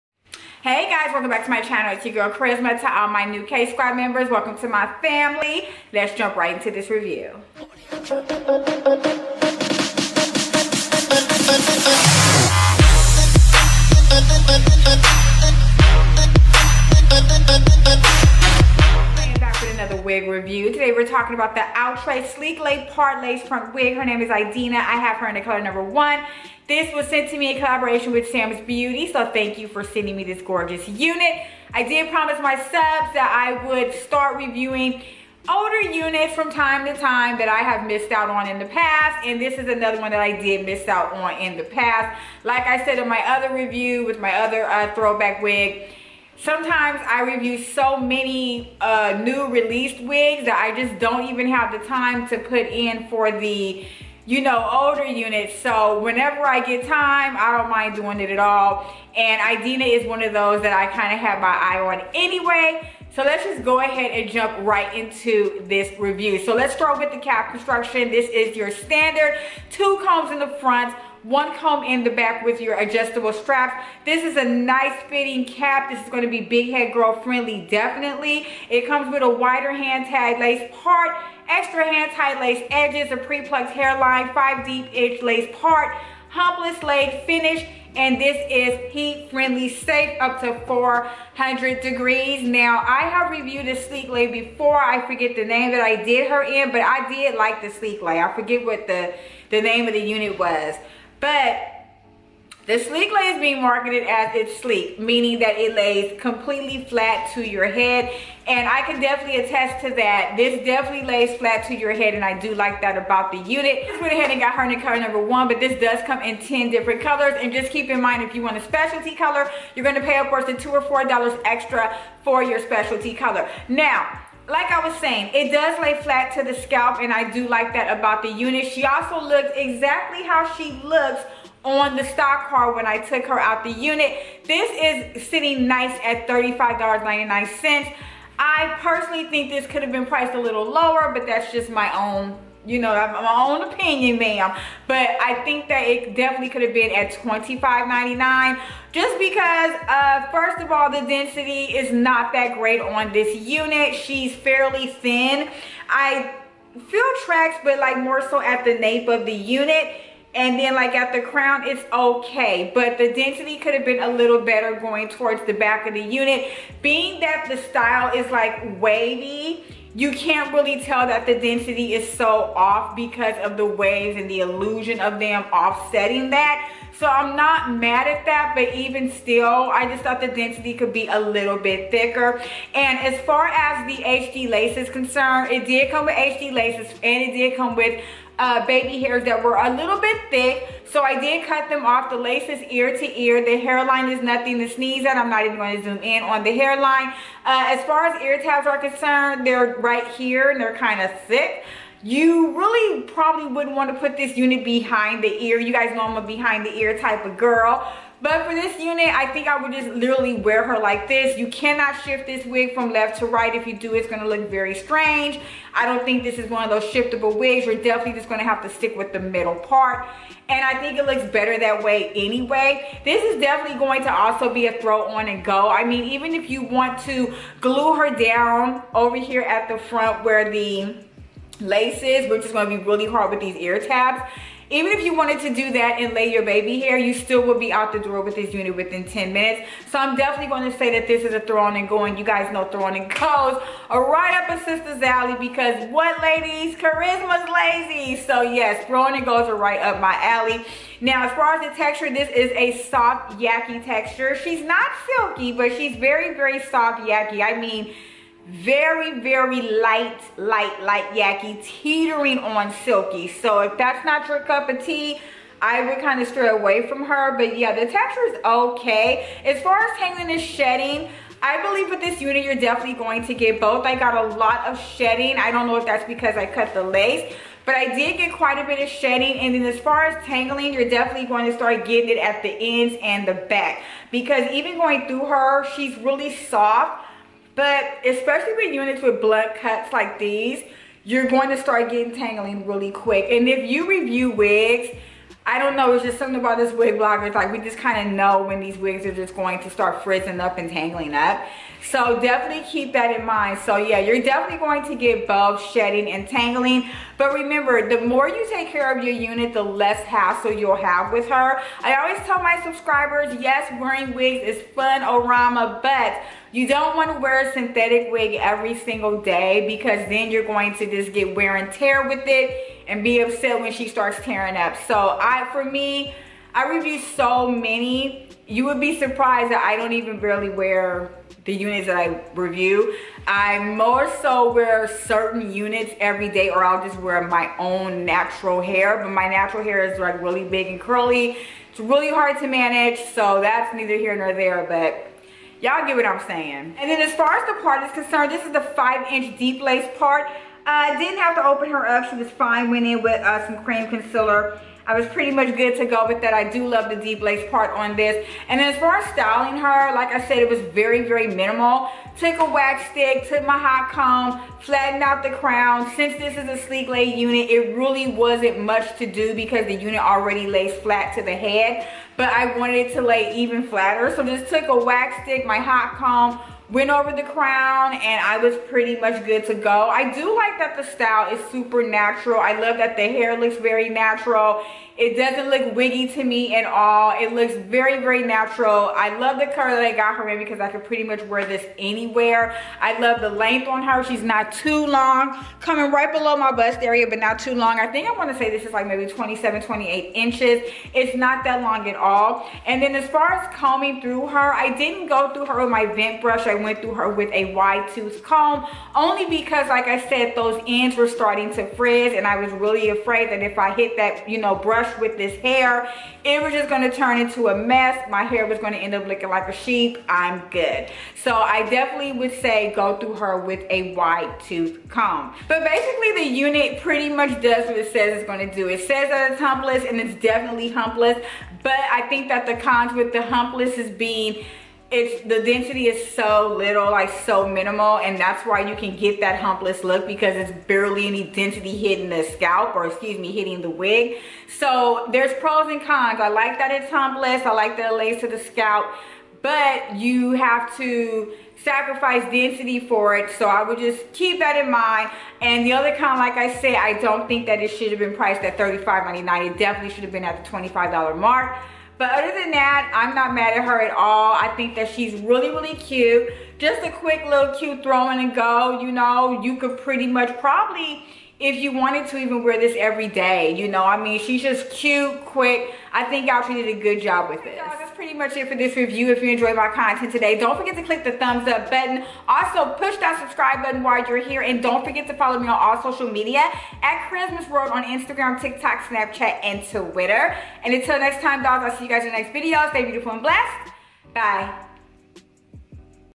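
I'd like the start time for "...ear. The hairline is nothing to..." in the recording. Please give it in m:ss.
3:13.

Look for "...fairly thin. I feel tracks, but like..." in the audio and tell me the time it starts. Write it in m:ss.
2:34.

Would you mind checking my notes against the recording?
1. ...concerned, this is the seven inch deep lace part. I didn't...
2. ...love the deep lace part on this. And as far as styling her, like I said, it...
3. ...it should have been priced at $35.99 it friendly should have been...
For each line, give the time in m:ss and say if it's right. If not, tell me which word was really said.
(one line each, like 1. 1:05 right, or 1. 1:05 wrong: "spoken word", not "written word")
1. 5:47 wrong: "five", not "seven"
2. 5:56 right
3. 7:37 wrong: "definitely", not "friendly".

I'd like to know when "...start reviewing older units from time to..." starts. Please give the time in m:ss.
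0:33.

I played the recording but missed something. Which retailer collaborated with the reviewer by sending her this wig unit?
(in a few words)
SamsBeauty.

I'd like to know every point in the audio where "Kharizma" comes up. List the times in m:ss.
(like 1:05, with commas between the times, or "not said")
0:02, 4:06, 8:07.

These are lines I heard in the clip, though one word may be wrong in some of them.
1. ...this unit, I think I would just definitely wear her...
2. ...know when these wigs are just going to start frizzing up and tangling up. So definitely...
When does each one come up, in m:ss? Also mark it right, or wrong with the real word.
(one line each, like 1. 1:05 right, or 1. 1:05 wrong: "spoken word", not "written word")
1. 3:28 wrong: "literally", not "definitely"
2. 4:58 right.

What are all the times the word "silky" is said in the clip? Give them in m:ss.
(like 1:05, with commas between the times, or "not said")
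4:15, 4:22.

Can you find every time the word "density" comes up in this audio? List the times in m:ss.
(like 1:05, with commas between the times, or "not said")
2:31, 2:43, 2:51, 3:00, 7:15, 7:21, 7:32.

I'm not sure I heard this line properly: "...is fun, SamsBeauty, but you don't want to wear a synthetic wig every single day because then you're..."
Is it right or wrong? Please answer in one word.
wrong.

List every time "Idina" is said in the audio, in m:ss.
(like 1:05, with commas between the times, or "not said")
0:24, 0:59.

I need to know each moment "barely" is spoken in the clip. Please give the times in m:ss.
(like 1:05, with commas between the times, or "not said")
5:30, 7:20.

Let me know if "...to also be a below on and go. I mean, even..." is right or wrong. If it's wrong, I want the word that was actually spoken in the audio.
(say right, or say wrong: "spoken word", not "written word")
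wrong: "throw", not "below".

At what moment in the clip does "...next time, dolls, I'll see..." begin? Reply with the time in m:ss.
8:10.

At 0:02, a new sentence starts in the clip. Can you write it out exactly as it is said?
To all my new K-Squad members, welcome to my family.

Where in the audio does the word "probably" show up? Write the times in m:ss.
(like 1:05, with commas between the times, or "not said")
3:23, 7:50.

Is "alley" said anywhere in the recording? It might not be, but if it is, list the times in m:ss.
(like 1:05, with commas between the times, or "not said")
4:05, 4:10.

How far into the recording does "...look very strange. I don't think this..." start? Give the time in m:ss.
3:34.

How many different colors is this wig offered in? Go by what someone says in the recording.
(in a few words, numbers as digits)
10.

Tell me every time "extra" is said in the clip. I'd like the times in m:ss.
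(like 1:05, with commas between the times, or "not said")
1:21, 2:01.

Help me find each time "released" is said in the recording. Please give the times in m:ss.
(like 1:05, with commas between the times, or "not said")
0:49.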